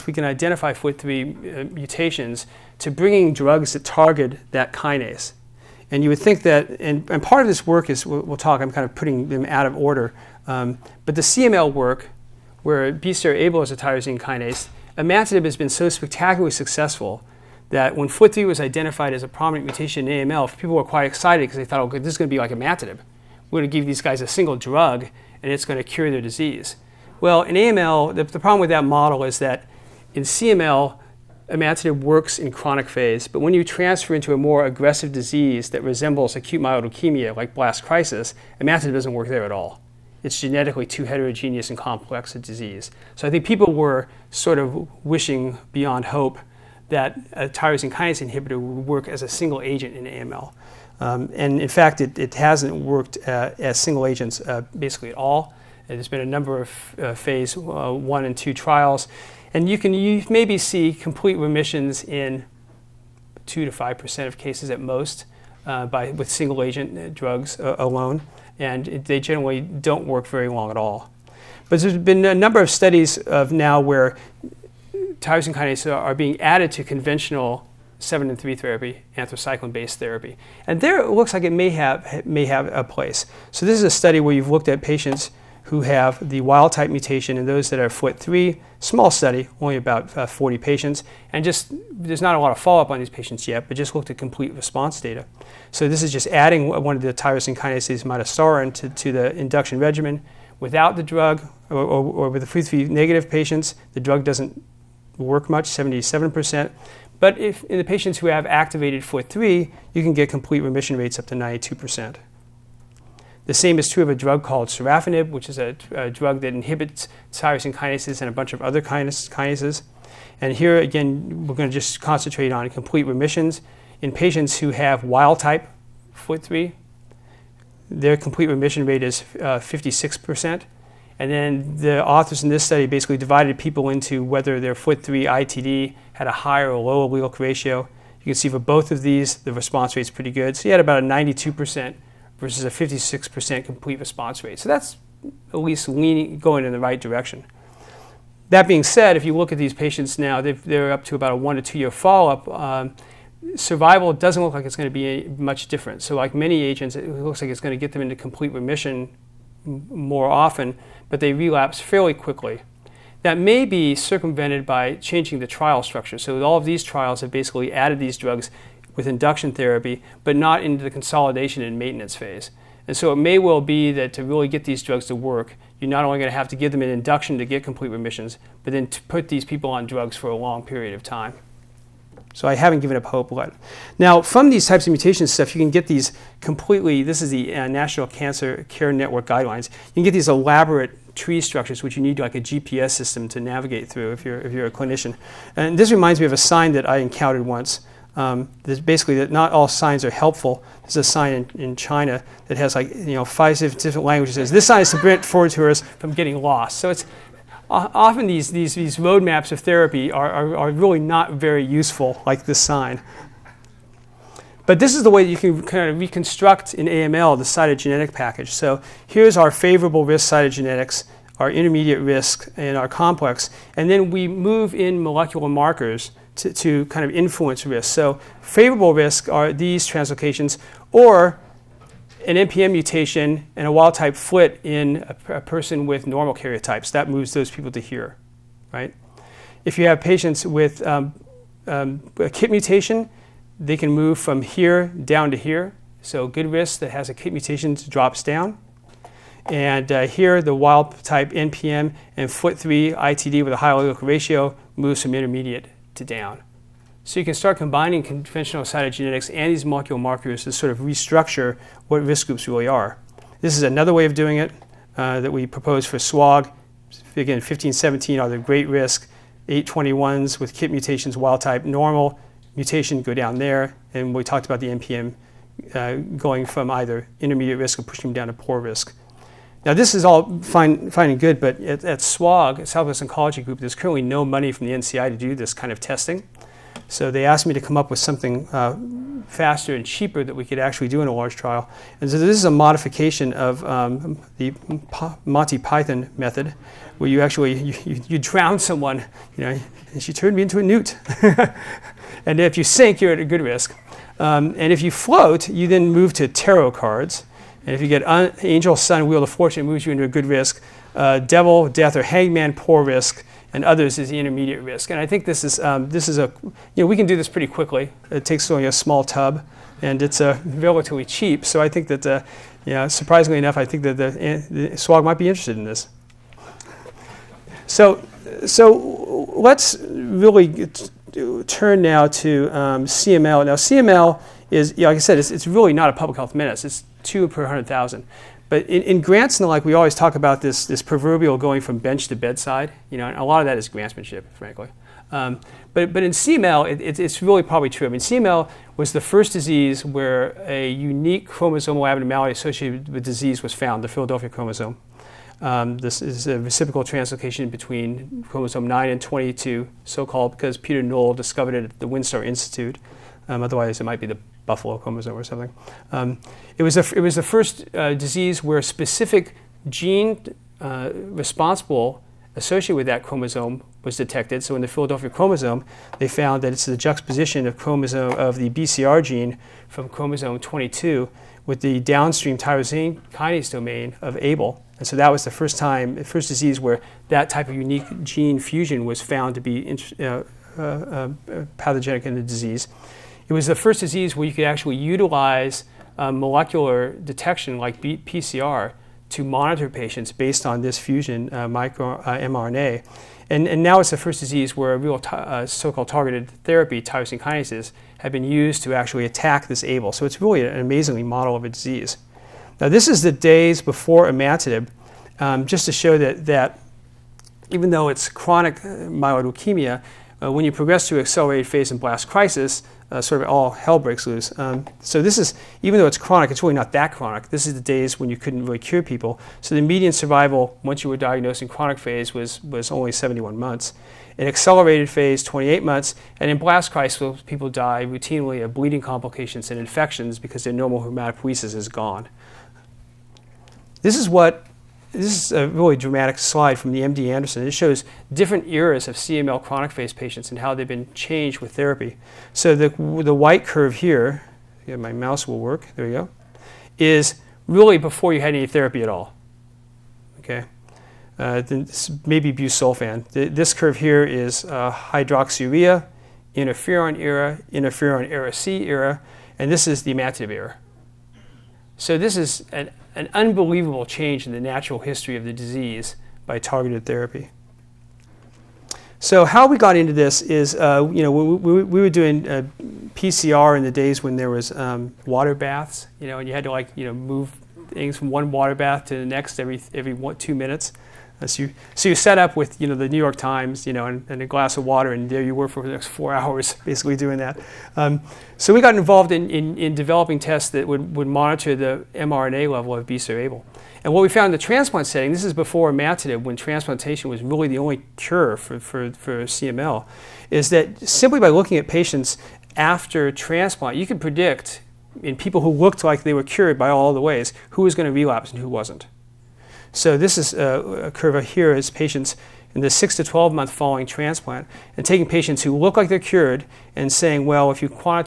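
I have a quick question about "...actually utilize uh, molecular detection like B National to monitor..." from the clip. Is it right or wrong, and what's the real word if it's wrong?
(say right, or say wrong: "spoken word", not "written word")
wrong: "PCR", not "National".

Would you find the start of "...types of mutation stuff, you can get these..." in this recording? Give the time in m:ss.
3:04.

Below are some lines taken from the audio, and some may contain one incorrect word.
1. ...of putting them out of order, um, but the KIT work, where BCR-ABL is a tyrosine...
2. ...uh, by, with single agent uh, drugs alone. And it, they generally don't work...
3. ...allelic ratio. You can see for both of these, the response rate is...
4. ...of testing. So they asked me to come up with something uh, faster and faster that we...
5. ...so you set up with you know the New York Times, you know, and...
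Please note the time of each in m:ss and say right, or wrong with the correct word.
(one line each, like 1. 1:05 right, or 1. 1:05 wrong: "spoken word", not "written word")
1. 0:08 wrong: "CML", not "KIT"
2. 1:05 right
3. 2:17 right
4. 4:45 wrong: "cheaper", not "faster"
5. 8:11 right.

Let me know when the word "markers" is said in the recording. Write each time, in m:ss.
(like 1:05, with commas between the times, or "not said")
3:45, 4:19.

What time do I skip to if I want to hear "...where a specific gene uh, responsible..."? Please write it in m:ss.
6:08.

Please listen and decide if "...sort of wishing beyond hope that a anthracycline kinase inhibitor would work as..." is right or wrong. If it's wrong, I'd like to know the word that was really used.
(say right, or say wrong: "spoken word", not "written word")
wrong: "tyrosine", not "anthracycline".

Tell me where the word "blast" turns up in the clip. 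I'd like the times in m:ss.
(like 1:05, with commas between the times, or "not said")
0:37, 7:01, 7:16.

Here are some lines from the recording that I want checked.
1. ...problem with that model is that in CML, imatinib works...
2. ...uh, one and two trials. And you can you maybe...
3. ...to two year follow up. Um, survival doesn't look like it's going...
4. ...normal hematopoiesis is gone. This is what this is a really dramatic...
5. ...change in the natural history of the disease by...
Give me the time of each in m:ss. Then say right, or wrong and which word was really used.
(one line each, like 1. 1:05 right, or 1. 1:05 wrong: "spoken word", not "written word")
1. 0:28 right
2. 0:57 right
3. 2:31 right
4. 7:20 right
5. 7:53 right.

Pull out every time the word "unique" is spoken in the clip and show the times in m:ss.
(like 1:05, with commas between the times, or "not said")
5:50, 6:27.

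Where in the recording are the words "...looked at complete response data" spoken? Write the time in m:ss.
1:33.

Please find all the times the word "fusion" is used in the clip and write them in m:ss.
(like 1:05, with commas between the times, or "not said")
6:28, 6:40.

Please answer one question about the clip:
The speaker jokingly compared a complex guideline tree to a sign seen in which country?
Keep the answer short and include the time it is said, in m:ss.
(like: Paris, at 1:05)
China, at 3:21.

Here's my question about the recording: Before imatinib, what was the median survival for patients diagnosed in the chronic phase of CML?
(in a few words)
71 months.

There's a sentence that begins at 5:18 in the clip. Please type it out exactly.
It takes only a small tub, and it's uh, relatively cheap.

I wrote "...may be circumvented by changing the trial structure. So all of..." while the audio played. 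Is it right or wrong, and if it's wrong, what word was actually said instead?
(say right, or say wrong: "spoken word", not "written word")
right.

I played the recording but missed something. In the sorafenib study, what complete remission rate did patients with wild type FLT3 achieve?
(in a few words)
56 percent.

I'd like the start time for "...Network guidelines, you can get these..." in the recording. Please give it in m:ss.
3:08.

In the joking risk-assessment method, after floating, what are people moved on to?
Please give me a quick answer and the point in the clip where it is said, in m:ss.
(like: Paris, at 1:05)
tarot cards, at 5:06.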